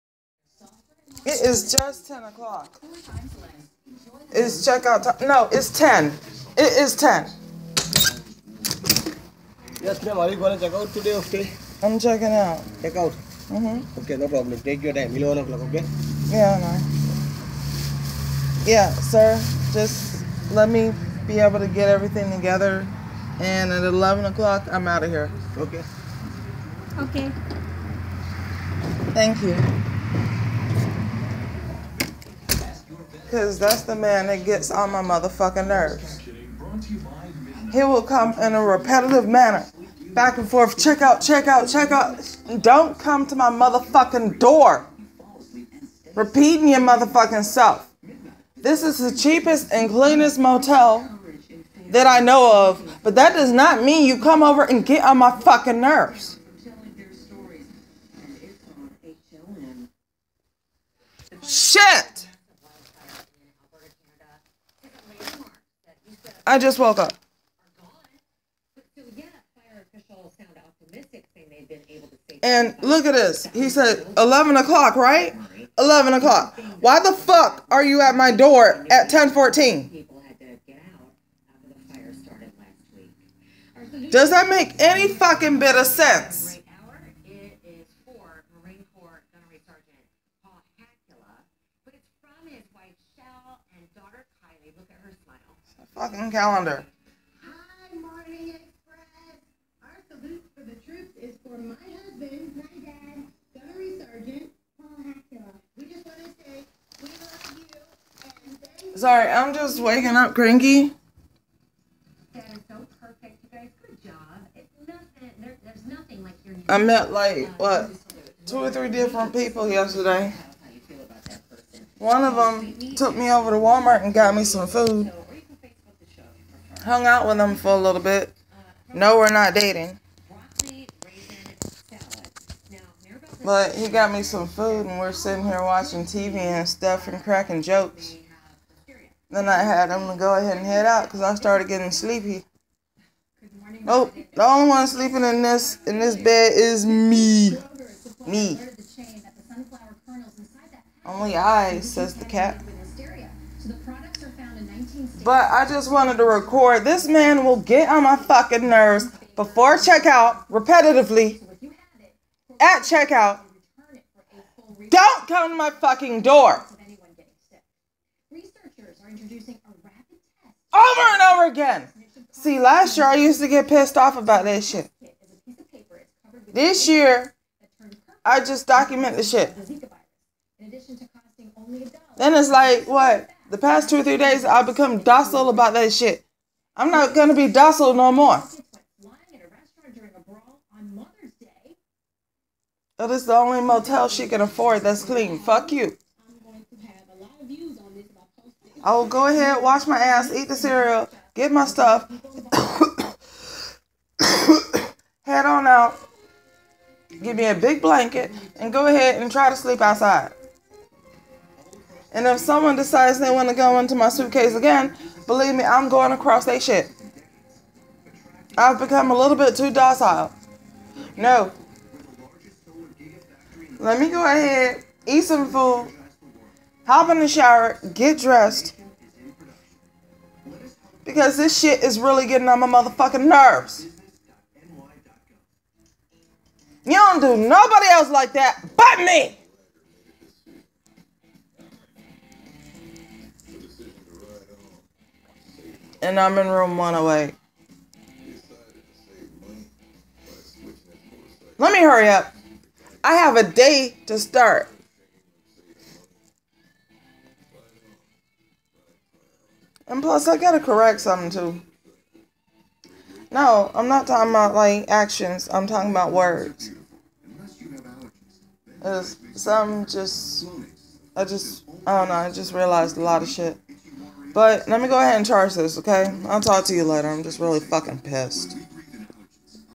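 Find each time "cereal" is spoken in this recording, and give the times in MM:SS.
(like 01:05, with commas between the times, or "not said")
03:20.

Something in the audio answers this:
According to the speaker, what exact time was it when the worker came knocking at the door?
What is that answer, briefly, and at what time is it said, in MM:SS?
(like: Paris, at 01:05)
10:14, at 01:19.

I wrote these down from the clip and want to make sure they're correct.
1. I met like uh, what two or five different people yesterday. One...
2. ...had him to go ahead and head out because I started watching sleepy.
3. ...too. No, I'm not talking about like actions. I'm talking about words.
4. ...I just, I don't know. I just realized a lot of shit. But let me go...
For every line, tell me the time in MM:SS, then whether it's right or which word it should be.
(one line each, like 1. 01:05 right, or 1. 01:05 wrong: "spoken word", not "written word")
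1. 01:56 wrong: "three", not "five"
2. 02:19 wrong: "getting", not "watching"
3. 04:21 right
4. 04:31 right.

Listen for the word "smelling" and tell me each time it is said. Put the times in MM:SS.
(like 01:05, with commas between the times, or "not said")
not said.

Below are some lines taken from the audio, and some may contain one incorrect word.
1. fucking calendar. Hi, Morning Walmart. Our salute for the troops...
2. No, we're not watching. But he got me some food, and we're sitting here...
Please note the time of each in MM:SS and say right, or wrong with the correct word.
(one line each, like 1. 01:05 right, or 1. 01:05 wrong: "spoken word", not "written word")
1. 01:36 wrong: "Express", not "Walmart"
2. 02:08 wrong: "dating", not "watching".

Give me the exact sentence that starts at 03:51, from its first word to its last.
Because this shit is really getting on my motherfucking nerves.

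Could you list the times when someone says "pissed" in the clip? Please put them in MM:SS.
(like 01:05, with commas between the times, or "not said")
02:53, 04:38.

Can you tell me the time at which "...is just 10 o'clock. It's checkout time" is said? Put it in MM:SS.
00:01.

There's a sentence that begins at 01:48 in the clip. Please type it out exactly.
And Sorry, I'm just waking up cranky.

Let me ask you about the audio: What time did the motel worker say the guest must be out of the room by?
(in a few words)
11 o'clock.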